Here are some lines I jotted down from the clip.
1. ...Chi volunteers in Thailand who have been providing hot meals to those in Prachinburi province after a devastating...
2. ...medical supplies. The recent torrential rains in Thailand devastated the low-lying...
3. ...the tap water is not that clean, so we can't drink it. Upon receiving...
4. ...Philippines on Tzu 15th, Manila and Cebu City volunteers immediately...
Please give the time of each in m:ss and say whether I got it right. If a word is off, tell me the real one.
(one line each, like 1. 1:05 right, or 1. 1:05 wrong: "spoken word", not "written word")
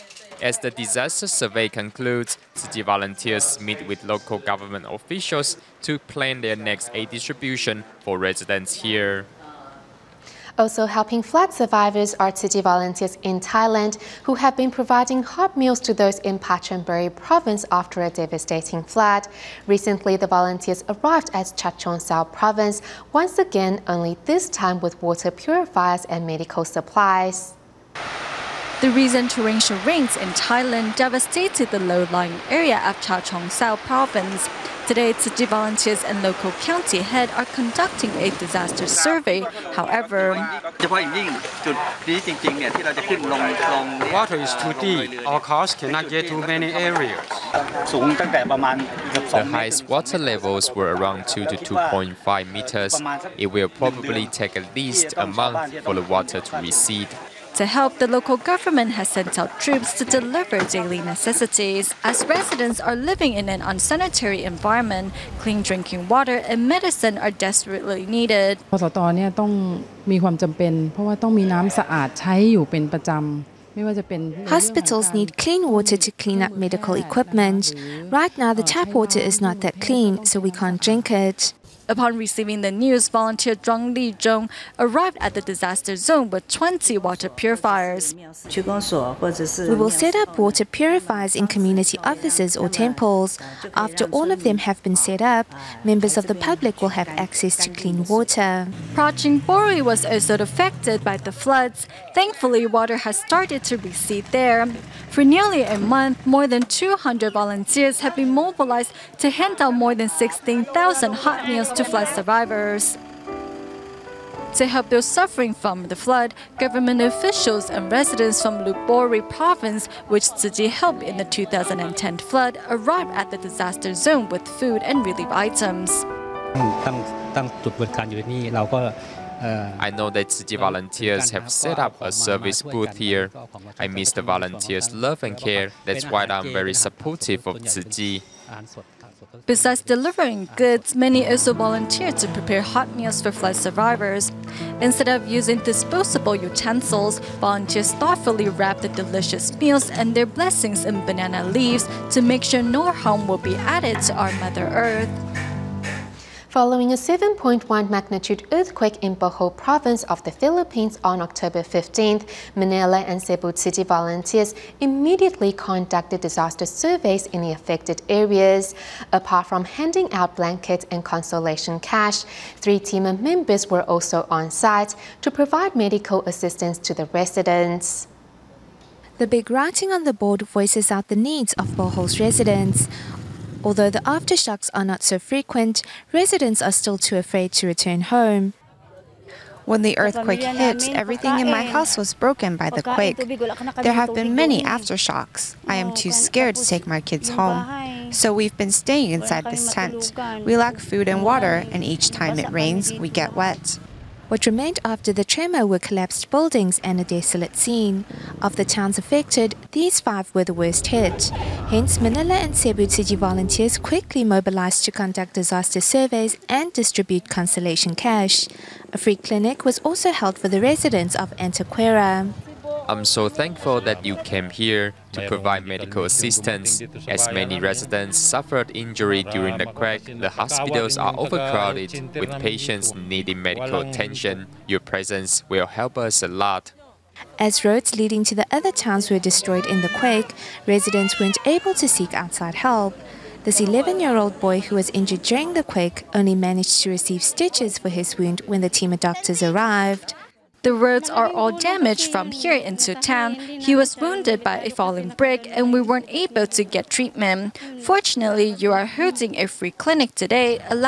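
1. 0:12 right
2. 0:26 right
3. 1:18 right
4. 2:40 wrong: "October", not "Tzu".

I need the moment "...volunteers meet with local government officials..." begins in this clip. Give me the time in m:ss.
0:02.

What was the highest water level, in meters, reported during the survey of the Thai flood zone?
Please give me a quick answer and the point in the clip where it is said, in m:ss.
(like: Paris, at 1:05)
2 to 2.5 meters, at 0:51.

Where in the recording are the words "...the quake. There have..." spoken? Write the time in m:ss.
3:12.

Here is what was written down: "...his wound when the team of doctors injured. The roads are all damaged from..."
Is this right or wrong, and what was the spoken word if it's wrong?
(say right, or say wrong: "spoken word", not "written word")
wrong: "arrived", not "injured".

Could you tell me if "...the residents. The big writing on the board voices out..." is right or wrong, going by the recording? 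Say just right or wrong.
right.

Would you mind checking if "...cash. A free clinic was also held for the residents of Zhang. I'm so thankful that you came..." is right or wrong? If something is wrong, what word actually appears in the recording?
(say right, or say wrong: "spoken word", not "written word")
wrong: "Antequera", not "Zhang".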